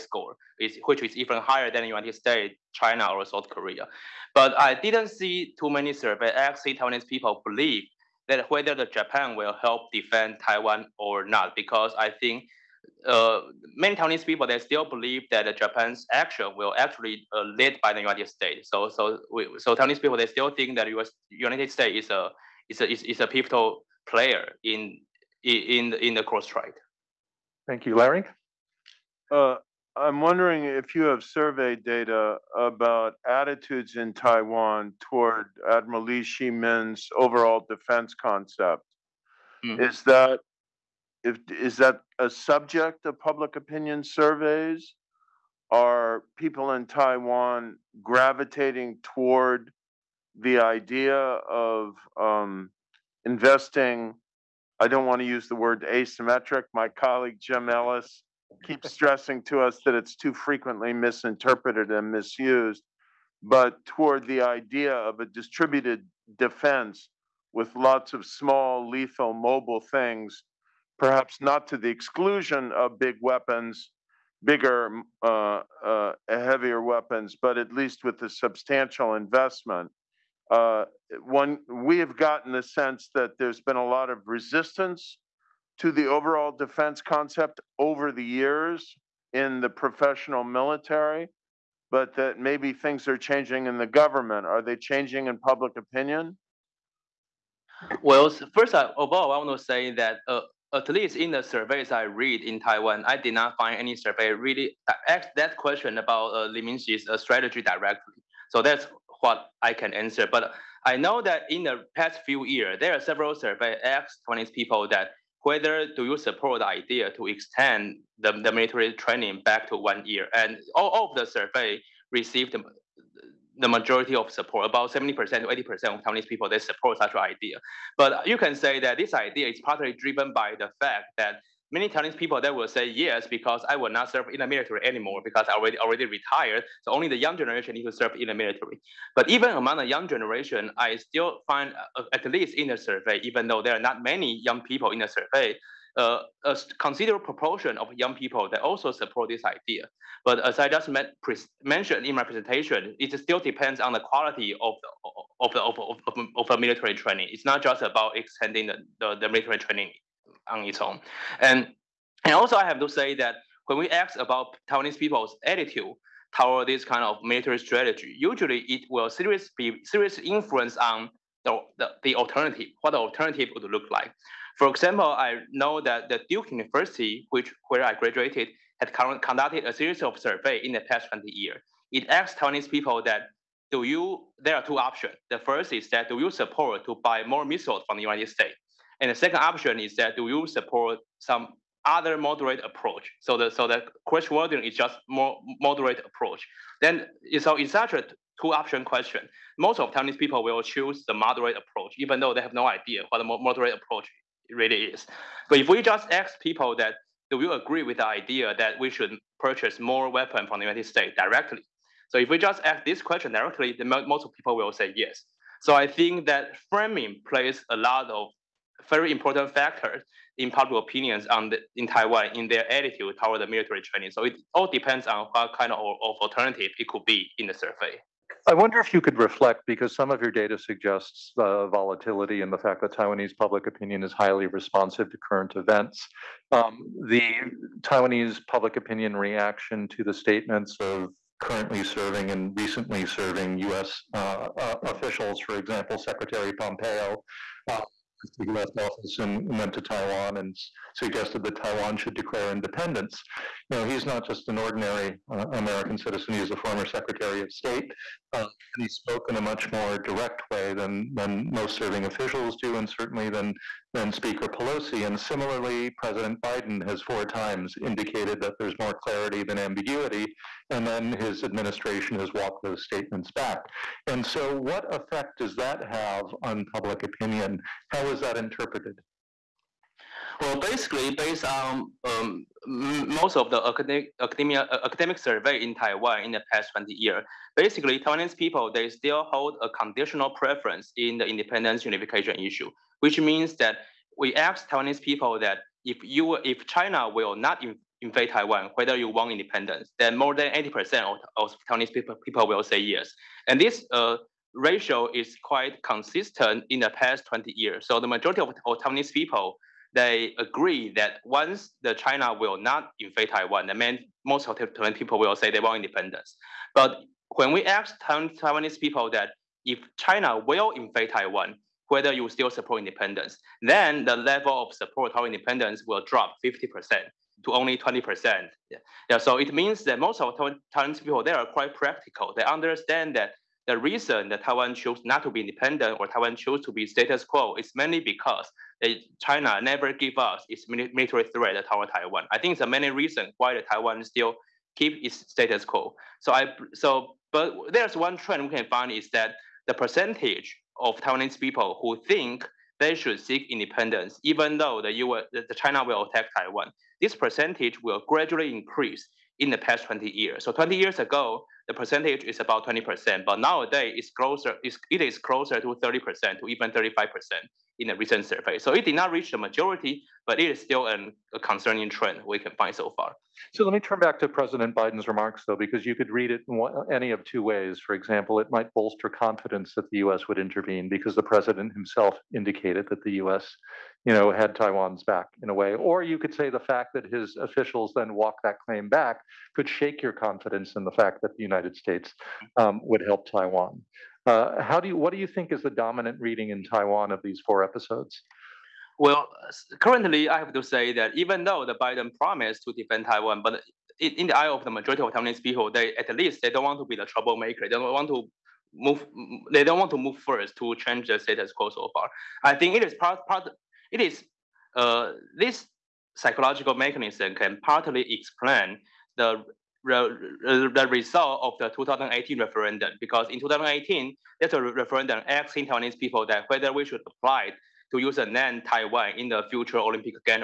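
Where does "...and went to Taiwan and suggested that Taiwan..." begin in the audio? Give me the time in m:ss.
4:09.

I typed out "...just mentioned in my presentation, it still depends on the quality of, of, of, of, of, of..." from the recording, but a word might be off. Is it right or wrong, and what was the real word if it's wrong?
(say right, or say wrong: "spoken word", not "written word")
right.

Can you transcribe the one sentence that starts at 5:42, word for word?
I think there are many reasons why the Taiwan still keep its status quo.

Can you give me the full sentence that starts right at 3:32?
So if we just ask this question directly, the most people will say yes.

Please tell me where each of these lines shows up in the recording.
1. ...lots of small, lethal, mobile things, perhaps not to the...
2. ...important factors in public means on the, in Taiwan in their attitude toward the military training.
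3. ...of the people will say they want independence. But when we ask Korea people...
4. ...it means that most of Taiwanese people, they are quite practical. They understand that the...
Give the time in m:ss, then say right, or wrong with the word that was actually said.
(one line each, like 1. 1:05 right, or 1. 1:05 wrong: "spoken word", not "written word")
1. 1:07 right
2. 3:39 wrong: "opinions", not "means"
3. 5:14 wrong: "Taiwanese", not "Korea"
4. 5:29 right.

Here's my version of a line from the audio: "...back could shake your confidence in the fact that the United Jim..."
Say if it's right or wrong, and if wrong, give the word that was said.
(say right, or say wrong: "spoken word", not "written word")
wrong: "States", not "Jim".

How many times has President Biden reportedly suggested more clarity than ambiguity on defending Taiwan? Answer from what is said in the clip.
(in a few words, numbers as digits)
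4.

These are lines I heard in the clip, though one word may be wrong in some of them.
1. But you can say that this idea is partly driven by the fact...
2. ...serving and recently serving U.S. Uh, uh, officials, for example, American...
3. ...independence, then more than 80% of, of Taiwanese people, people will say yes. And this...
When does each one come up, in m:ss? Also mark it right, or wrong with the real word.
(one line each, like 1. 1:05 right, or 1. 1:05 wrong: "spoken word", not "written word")
1. 2:07 right
2. 4:01 wrong: "Secretary", not "American"
3. 4:59 right.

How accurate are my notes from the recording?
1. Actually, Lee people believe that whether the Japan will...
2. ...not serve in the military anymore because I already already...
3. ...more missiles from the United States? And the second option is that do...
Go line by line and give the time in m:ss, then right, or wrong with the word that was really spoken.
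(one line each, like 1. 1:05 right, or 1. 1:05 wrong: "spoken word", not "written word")
1. 0:06 wrong: "Taiwanese", not "Lee"
2. 2:13 right
3. 3:07 right.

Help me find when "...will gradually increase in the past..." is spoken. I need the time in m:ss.
5:57.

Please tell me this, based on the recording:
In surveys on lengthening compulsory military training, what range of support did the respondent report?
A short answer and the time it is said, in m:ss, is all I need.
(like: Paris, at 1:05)
70% to 80%, at 2:04.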